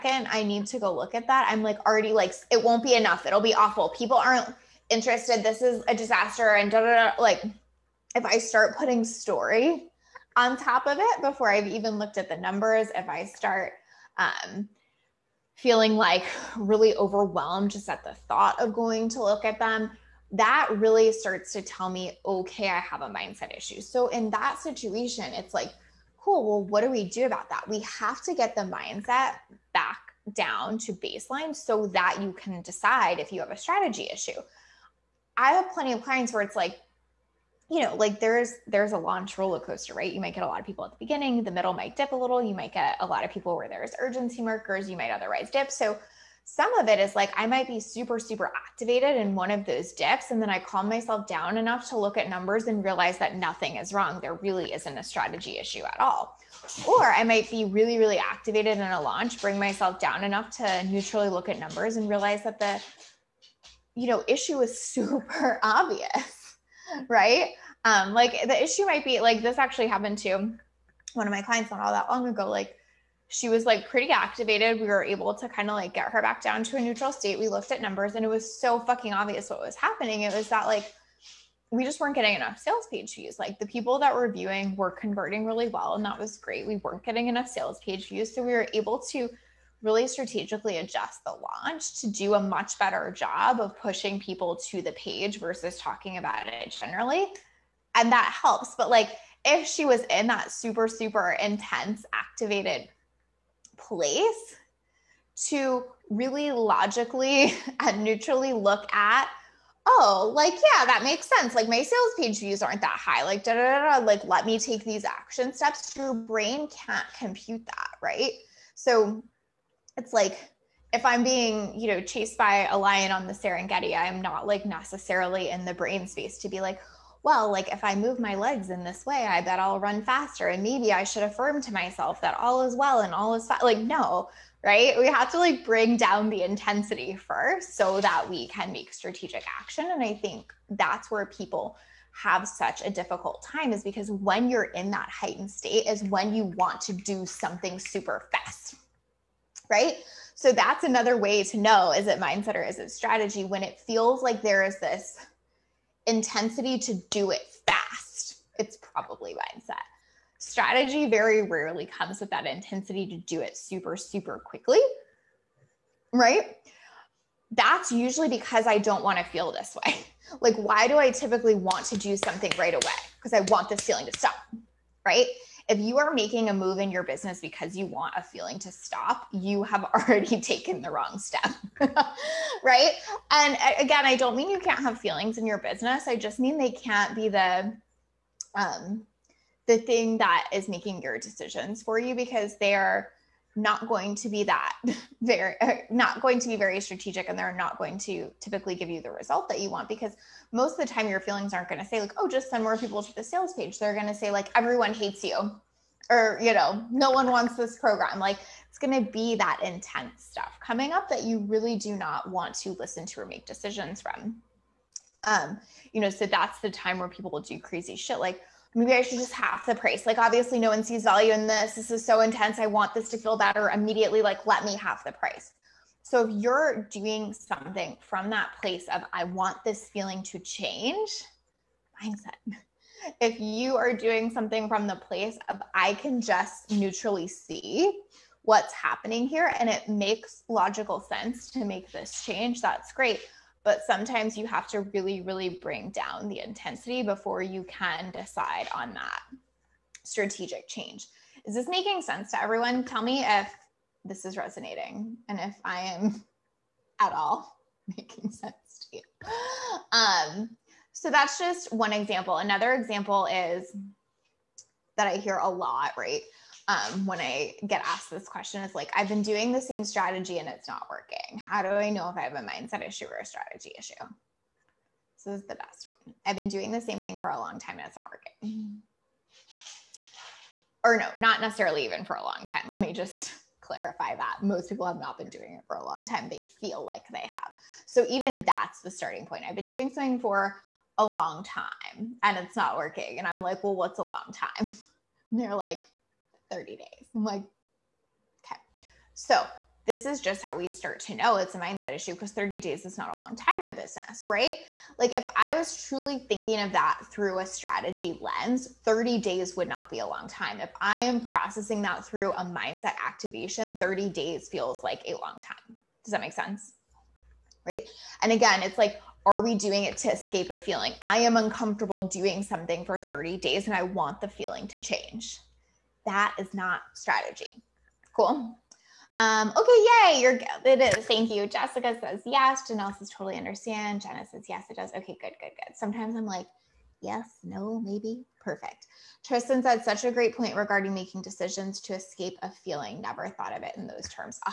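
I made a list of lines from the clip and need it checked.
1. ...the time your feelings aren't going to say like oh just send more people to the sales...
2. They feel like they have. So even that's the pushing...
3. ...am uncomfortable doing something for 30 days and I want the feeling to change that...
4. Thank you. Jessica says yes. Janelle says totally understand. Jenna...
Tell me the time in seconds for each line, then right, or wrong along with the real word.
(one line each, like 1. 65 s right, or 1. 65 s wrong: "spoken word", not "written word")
1. 200 s right
2. 286 s wrong: "starting", not "pushing"
3. 321 s right
4. 331 s right.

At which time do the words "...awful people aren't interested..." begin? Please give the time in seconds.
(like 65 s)
3 s.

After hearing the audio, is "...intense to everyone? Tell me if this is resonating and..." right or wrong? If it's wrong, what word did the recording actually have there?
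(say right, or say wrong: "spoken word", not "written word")
wrong: "sense", not "intense".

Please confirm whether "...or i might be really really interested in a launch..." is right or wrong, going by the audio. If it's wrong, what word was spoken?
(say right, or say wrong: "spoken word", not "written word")
wrong: "activated", not "interested".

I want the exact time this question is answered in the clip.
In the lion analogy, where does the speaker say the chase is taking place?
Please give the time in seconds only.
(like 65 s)
123 s.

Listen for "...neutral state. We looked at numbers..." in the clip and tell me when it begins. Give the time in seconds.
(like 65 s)
76 s.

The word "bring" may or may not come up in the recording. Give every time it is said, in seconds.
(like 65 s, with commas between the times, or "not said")
59 s, 135 s, 245 s.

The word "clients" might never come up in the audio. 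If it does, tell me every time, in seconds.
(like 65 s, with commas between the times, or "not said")
36 s, 71 s.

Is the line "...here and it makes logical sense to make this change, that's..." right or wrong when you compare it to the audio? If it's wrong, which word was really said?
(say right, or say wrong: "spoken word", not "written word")
right.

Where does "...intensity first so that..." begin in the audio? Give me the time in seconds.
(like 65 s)
136 s.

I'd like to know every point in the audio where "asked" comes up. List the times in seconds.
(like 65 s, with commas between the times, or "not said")
267 s.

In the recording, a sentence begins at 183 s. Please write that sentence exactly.
And again, I don't mean you can't have feelings in your business.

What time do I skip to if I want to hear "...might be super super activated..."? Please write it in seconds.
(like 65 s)
47 s.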